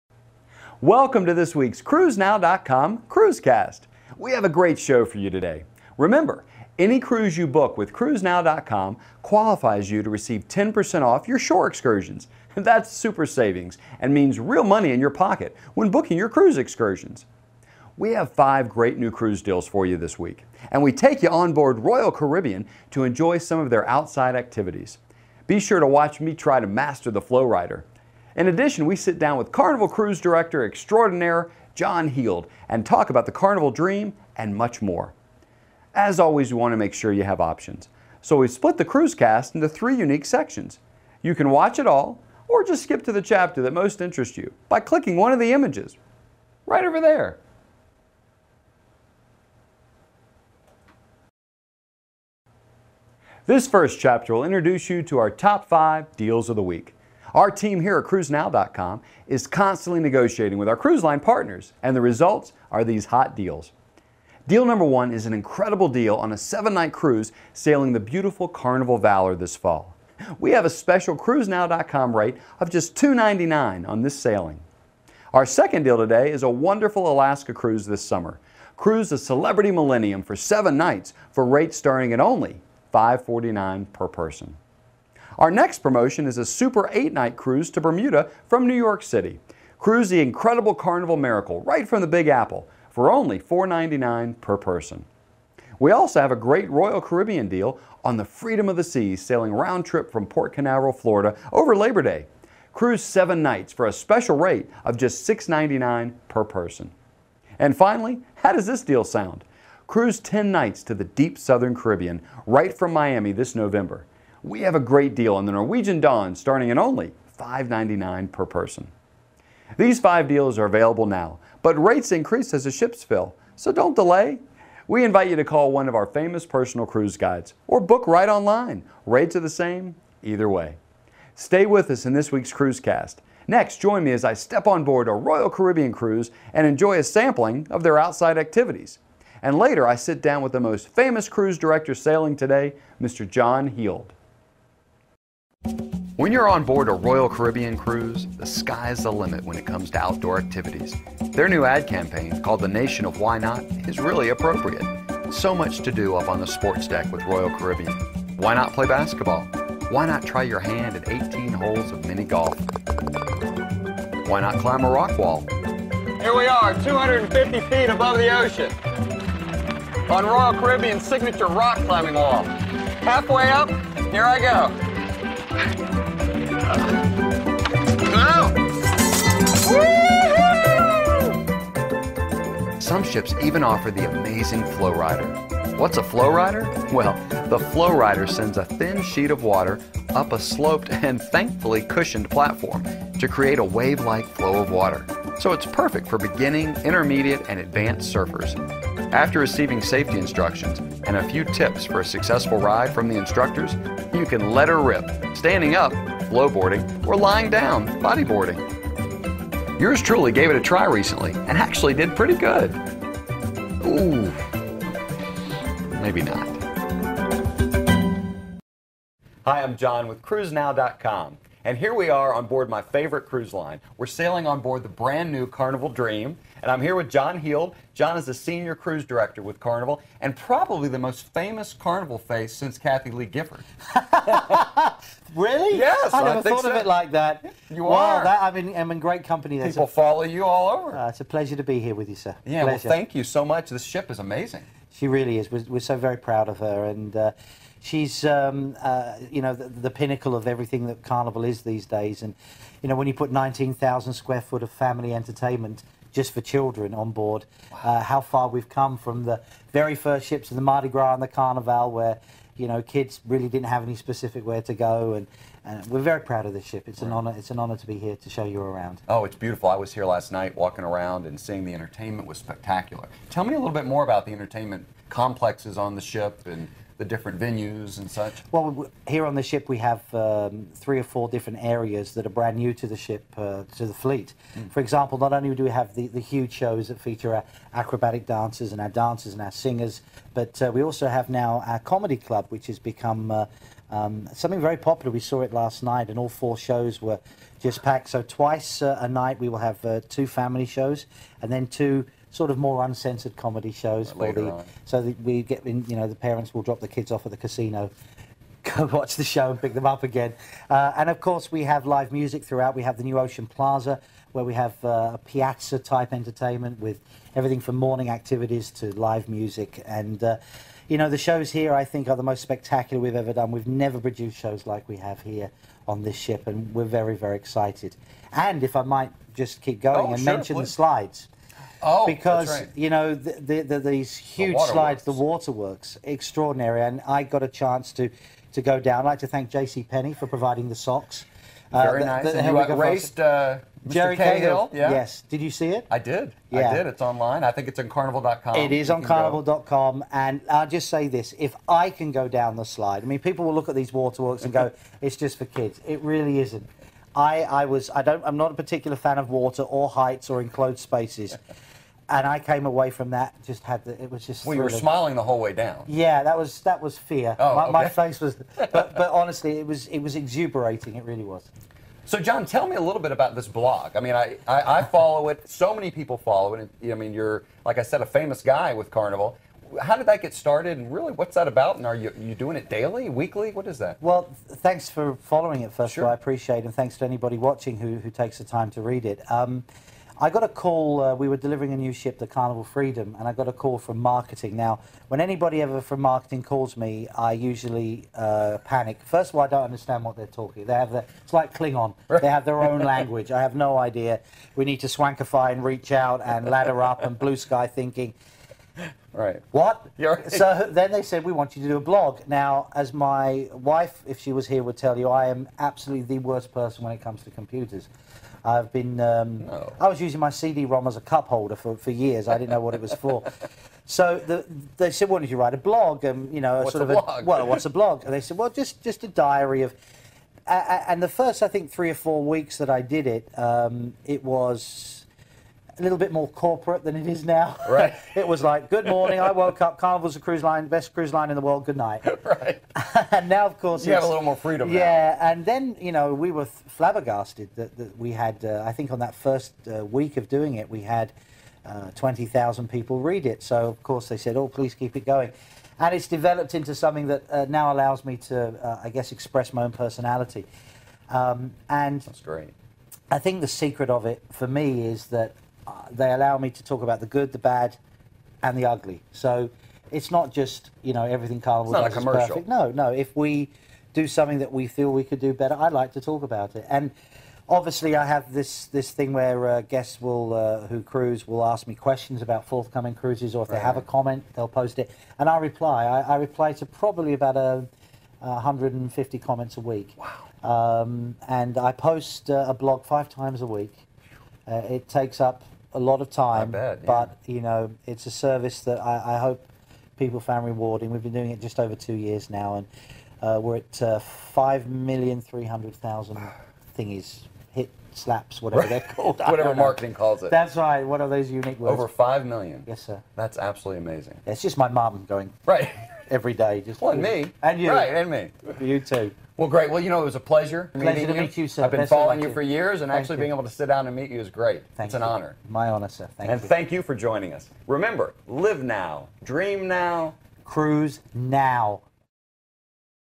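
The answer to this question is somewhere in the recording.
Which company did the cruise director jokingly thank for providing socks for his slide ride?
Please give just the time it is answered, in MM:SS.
05:39.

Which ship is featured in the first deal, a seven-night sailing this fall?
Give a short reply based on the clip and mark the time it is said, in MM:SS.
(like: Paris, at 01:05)
Carnival Valor, at 01:08.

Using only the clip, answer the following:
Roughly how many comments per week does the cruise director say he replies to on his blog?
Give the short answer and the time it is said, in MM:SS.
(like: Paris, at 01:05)
150, at 08:08.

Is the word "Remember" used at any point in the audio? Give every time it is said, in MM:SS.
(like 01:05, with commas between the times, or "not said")
00:05, 08:47.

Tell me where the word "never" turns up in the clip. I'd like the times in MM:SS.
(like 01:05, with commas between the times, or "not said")
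03:56, 05:23.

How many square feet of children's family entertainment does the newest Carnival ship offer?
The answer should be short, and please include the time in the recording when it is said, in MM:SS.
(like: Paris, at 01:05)
19,000, at 04:13.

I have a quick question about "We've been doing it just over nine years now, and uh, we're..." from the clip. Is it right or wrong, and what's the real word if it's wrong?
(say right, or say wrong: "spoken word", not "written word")
wrong: "two", not "nine".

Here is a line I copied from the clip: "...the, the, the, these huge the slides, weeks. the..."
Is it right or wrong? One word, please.
wrong.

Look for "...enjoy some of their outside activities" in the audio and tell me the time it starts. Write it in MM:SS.
00:23.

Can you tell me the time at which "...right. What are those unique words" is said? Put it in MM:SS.
08:30.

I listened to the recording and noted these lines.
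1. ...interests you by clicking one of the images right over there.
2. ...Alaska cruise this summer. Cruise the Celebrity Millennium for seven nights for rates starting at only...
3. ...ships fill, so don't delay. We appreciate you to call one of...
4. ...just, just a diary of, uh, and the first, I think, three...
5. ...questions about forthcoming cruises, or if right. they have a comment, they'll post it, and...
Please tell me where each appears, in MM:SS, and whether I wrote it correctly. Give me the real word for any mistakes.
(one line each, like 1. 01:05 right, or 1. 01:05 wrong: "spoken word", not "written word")
1. 00:43 right
2. 01:17 right
3. 02:02 wrong: "invite", not "appreciate"
4. 07:08 right
5. 08:01 right.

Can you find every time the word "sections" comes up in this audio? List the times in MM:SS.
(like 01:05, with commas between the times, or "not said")
00:40.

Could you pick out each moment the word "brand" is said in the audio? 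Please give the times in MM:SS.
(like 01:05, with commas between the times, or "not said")
03:44, 04:42.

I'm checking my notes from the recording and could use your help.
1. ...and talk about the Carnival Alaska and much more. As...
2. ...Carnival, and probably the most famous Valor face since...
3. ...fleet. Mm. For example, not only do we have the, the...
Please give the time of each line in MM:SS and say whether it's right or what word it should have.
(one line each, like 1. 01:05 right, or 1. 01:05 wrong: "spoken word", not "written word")
1. 00:32 wrong: "Dream", not "Alaska"
2. 03:49 wrong: "Carnival", not "Valor"
3. 04:43 right.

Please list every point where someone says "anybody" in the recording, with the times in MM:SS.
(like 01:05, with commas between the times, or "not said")
06:27, 06:35.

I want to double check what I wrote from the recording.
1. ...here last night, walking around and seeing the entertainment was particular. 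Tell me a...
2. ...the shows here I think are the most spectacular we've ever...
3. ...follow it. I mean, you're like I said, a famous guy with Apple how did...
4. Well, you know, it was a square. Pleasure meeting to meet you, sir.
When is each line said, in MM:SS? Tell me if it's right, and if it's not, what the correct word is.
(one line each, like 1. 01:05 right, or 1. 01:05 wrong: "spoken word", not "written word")
1. 04:29 wrong: "spectacular", not "particular"
2. 05:21 right
3. 06:16 wrong: "Carnival", not "Apple"
4. 08:39 wrong: "pleasure", not "square".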